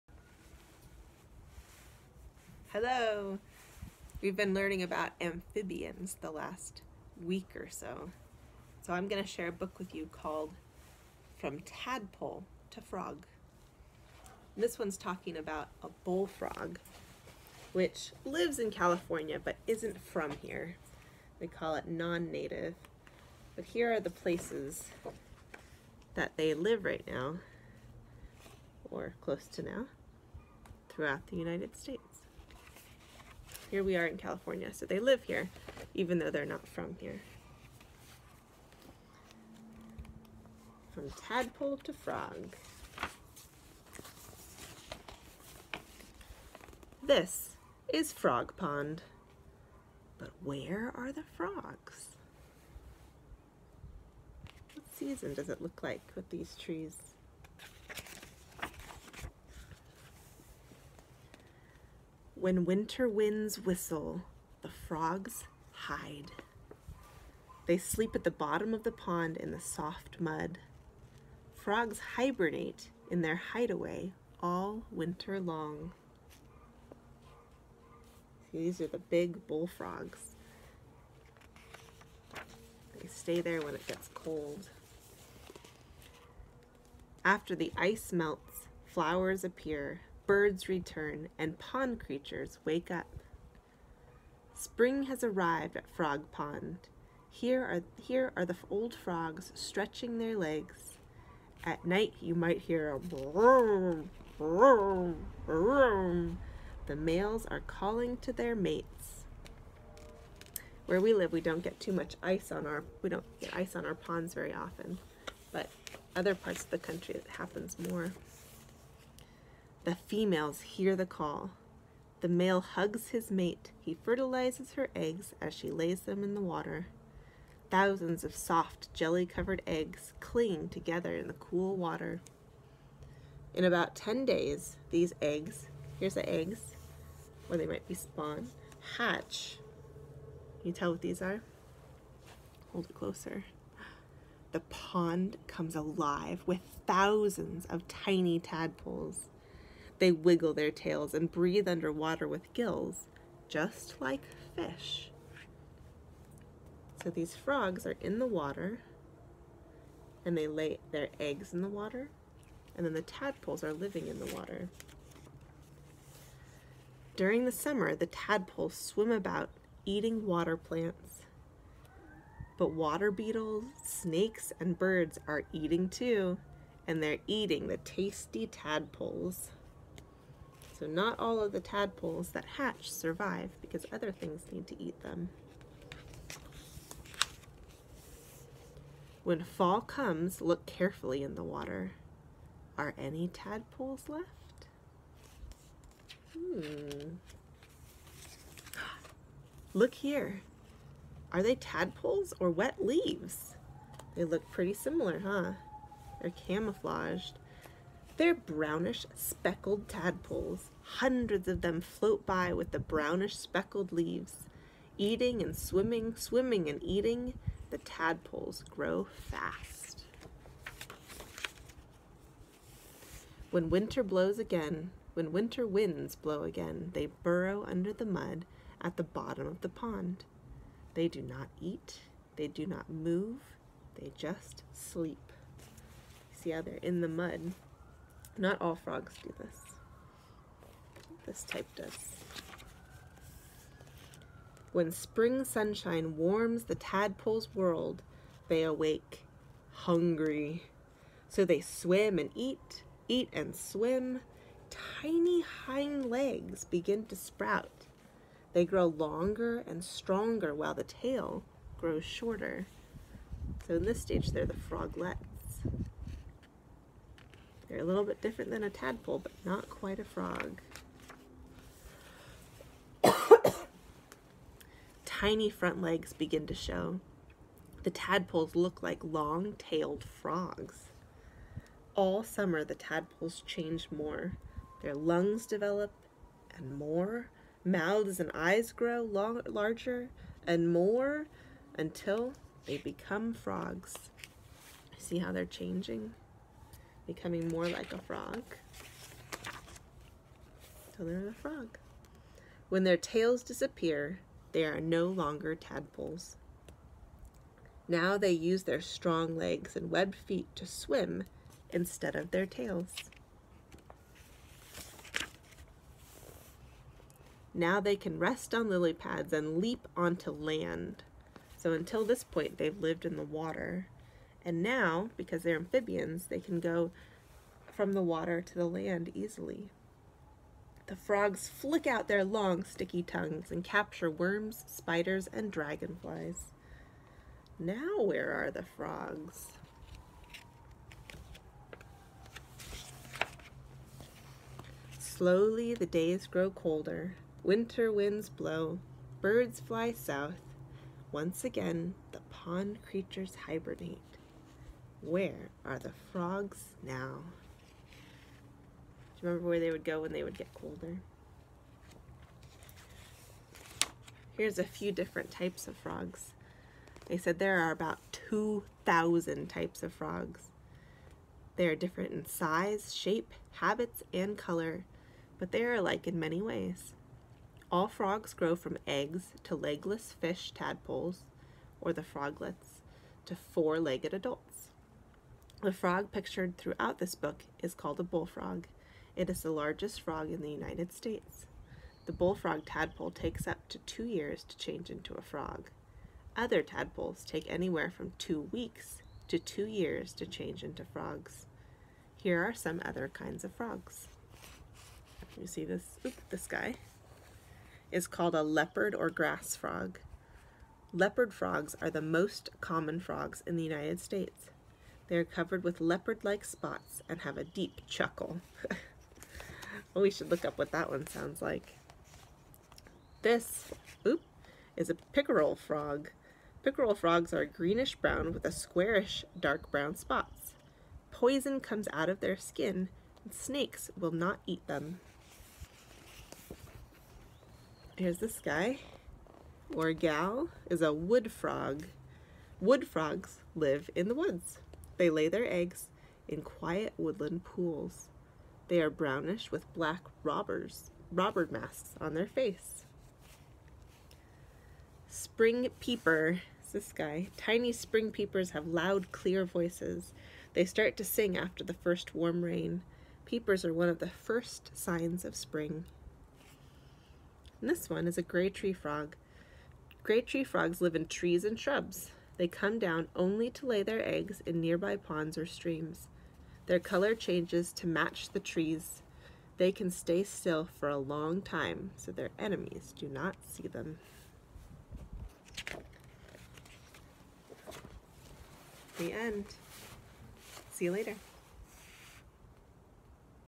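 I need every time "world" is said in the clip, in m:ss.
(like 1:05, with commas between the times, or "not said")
4:07.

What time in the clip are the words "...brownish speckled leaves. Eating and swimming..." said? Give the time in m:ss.
3:32.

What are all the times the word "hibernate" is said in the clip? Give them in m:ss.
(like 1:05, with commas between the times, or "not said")
1:12, 5:53.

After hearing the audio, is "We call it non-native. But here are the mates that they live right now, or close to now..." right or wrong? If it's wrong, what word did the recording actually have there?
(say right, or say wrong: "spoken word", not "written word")
wrong: "places", not "mates".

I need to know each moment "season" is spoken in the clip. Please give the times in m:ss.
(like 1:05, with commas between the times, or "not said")
0:54.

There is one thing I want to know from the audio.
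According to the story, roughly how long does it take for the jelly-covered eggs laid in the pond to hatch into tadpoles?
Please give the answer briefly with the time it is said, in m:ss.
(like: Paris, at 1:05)
10 days, at 2:13.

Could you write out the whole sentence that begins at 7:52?
They come down only to lay their eggs in nearby ponds or streams.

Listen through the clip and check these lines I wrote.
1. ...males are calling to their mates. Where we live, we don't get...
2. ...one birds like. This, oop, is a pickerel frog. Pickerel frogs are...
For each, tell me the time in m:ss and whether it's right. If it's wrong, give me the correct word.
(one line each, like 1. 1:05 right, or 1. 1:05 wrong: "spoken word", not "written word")
1. 1:46 right
2. 7:00 wrong: "sounds", not "birds".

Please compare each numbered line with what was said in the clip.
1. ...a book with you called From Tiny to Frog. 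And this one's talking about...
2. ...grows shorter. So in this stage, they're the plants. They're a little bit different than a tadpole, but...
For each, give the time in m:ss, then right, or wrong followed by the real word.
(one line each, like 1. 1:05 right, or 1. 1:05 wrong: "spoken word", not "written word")
1. 0:09 wrong: "Tadpole", not "Tiny"
2. 4:21 wrong: "froglets", not "plants".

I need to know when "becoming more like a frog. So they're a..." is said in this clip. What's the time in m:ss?
4:57.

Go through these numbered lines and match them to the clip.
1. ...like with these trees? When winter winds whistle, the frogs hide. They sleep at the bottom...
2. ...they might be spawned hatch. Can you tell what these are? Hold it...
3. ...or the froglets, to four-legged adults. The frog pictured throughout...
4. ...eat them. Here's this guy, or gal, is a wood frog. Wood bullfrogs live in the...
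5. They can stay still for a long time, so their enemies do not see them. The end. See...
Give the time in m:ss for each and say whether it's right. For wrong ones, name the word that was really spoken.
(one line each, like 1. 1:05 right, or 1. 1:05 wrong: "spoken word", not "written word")
1. 0:55 right
2. 2:17 right
3. 6:21 right
4. 7:14 wrong: "frogs", not "bullfrogs"
5. 7:59 right.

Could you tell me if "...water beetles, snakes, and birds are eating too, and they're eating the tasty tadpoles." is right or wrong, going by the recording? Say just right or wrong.
right.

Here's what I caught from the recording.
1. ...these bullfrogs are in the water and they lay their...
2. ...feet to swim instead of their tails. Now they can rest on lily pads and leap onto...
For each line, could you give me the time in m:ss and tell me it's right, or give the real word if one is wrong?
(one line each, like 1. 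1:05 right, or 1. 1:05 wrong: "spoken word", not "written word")
1. 2:37 wrong: "frogs", not "bullfrogs"
2. 5:10 right.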